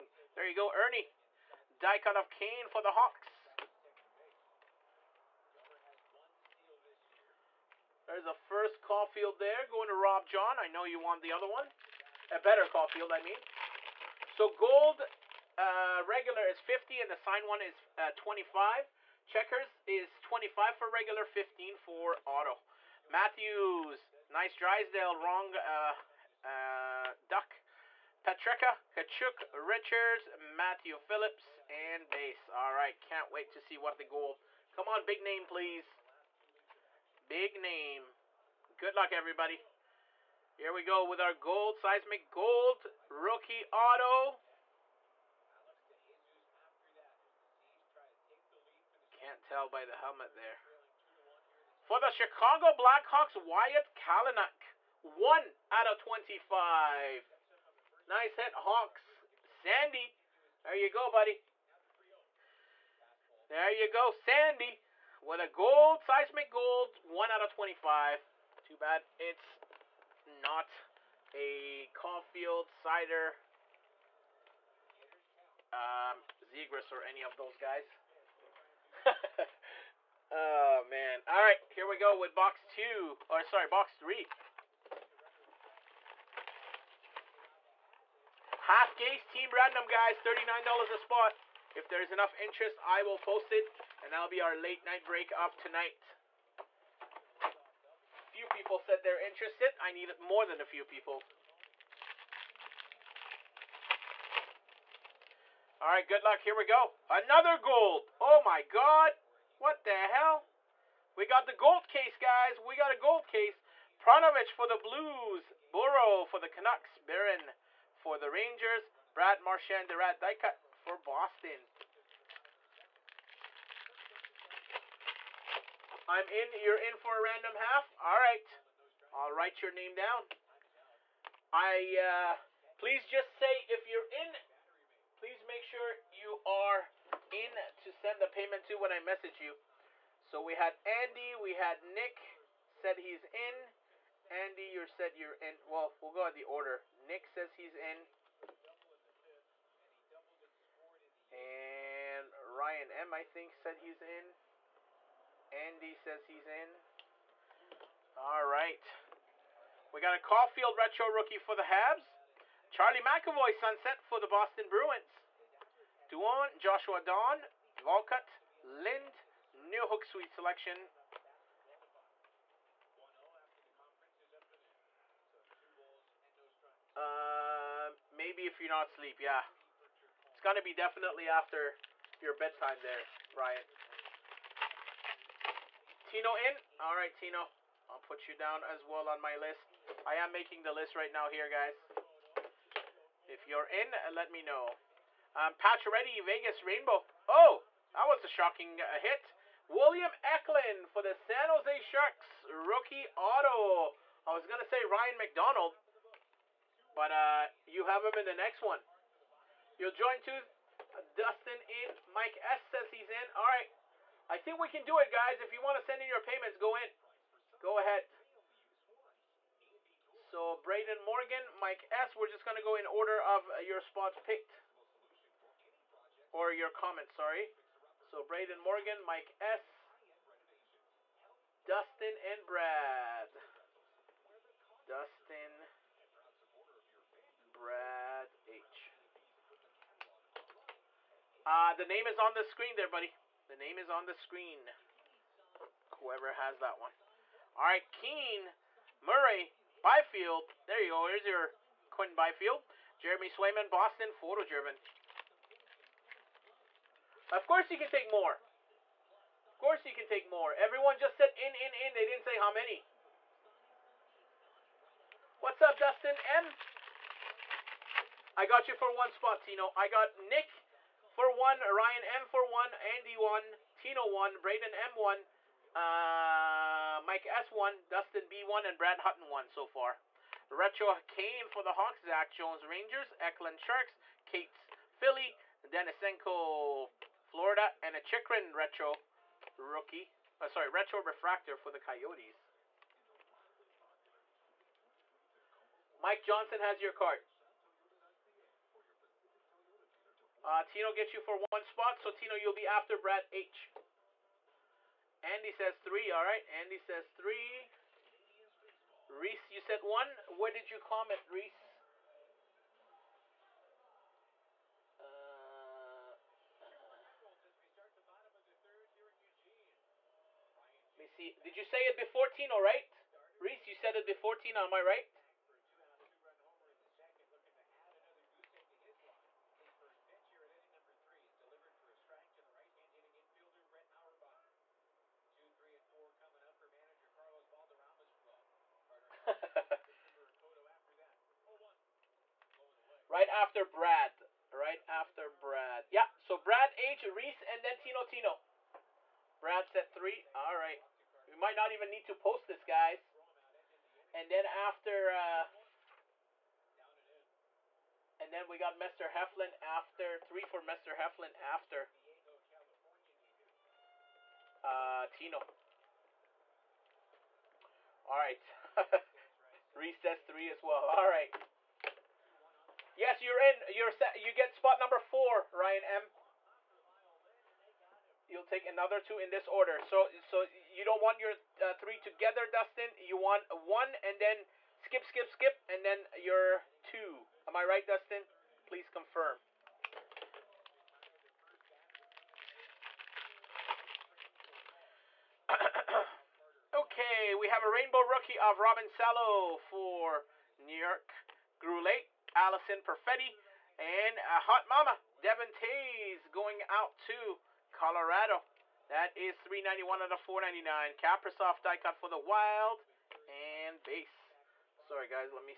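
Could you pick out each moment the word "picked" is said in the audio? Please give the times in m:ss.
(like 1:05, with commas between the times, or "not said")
3:44.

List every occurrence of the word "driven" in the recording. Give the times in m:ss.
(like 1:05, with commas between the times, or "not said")
4:14.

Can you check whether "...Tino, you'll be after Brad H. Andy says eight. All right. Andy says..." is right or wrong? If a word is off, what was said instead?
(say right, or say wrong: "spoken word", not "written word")
wrong: "three", not "eight".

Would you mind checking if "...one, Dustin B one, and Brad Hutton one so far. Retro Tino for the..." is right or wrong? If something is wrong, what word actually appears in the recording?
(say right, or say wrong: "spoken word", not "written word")
wrong: "Kane", not "Tino".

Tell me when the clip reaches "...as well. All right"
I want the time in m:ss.
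6:10.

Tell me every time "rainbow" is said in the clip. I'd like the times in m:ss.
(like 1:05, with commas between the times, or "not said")
3:16, 6:37.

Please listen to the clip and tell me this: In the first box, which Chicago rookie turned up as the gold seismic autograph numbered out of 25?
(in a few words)
Wyatt Kalynuk.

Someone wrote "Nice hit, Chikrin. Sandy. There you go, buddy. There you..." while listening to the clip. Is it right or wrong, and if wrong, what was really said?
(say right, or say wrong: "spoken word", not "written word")
wrong: "Hawks", not "Chikrin".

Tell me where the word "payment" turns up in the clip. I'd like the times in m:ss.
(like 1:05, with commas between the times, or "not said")
2:18, 3:36.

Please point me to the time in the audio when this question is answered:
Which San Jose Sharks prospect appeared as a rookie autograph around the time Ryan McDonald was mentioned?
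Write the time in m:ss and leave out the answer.
3:19.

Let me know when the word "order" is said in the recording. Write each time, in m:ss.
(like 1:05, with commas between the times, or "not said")
2:26, 3:42, 6:19.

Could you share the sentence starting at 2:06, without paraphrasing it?
You're in for a random half.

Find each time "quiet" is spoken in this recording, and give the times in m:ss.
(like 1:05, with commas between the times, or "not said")
not said.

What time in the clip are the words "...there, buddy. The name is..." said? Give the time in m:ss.
4:02.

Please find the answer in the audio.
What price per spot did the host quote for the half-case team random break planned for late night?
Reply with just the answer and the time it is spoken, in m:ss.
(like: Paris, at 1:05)
$39, at 1:30.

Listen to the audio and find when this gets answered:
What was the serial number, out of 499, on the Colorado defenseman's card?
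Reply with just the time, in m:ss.
6:49.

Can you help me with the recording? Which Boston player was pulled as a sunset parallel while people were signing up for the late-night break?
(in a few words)
Charlie McAvoy.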